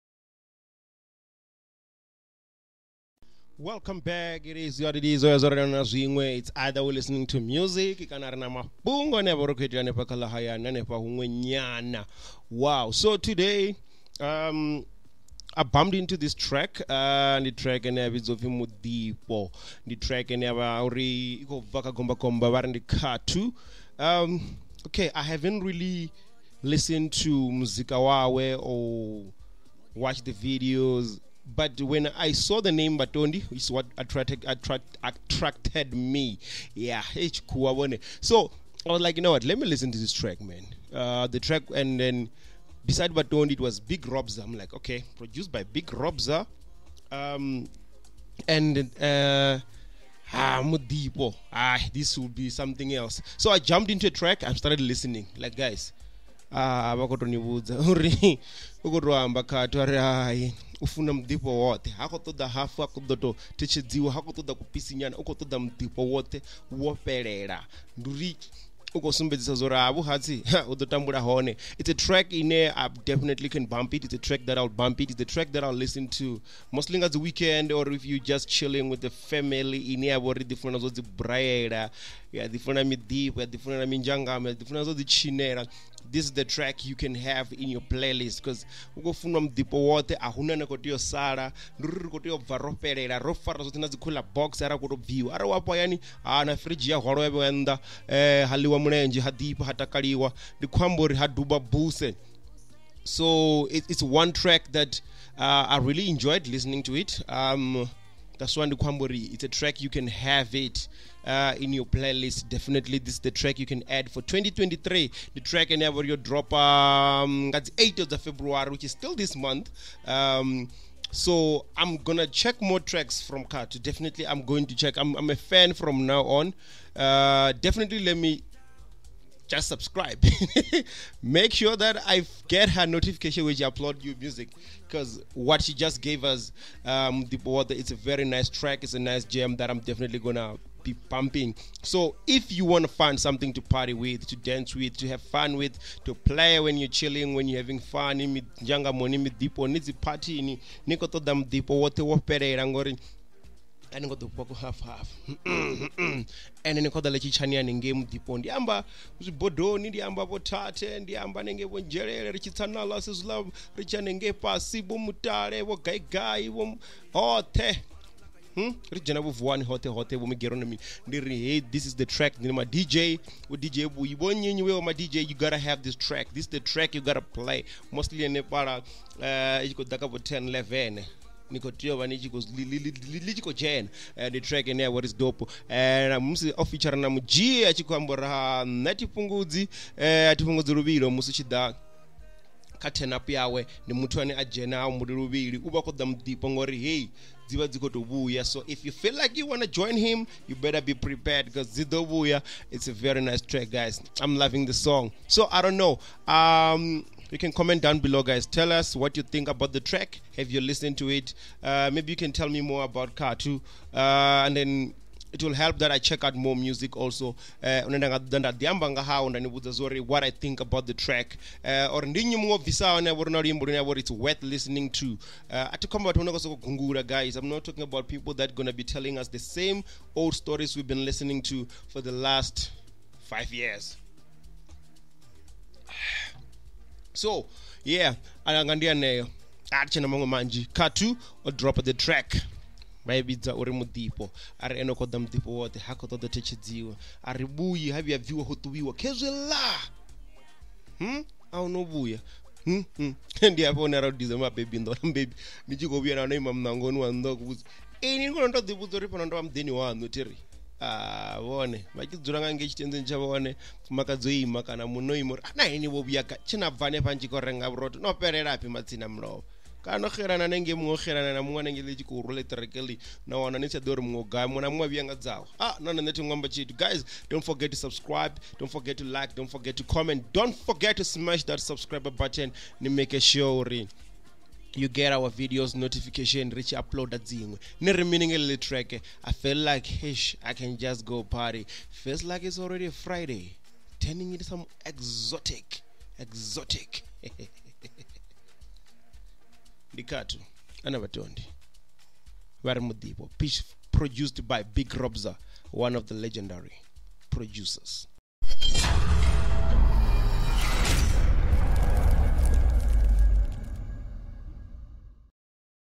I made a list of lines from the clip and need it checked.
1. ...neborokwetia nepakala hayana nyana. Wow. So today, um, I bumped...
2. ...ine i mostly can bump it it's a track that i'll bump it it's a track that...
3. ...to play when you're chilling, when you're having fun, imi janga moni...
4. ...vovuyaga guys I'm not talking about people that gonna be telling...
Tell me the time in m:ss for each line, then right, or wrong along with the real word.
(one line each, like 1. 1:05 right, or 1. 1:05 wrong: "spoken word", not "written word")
1. 0:09 right
2. 1:12 wrong: "definitely", not "mostly"
3. 2:26 right
4. 3:46 wrong: "unonga", not "vovuyaga".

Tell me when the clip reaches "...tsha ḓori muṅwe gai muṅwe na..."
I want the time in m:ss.
4:33.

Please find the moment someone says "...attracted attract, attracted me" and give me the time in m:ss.
0:33.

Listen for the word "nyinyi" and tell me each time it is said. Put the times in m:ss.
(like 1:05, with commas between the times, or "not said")
2:54.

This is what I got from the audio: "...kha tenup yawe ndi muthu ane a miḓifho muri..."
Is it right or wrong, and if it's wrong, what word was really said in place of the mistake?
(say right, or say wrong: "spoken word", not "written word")
wrong: "dzhenaho", not "miḓifho".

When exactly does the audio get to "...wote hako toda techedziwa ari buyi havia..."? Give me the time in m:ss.
4:05.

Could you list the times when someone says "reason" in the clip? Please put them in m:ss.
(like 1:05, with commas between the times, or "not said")
not said.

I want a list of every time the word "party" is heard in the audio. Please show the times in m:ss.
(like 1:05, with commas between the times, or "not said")
2:23, 2:29, 4:51.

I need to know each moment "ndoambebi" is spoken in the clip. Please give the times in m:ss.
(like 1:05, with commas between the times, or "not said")
4:14.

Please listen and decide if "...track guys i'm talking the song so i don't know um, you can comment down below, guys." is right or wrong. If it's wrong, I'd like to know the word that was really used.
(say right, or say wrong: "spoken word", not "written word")
wrong: "loving", not "talking".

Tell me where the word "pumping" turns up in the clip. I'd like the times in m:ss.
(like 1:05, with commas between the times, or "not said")
2:21.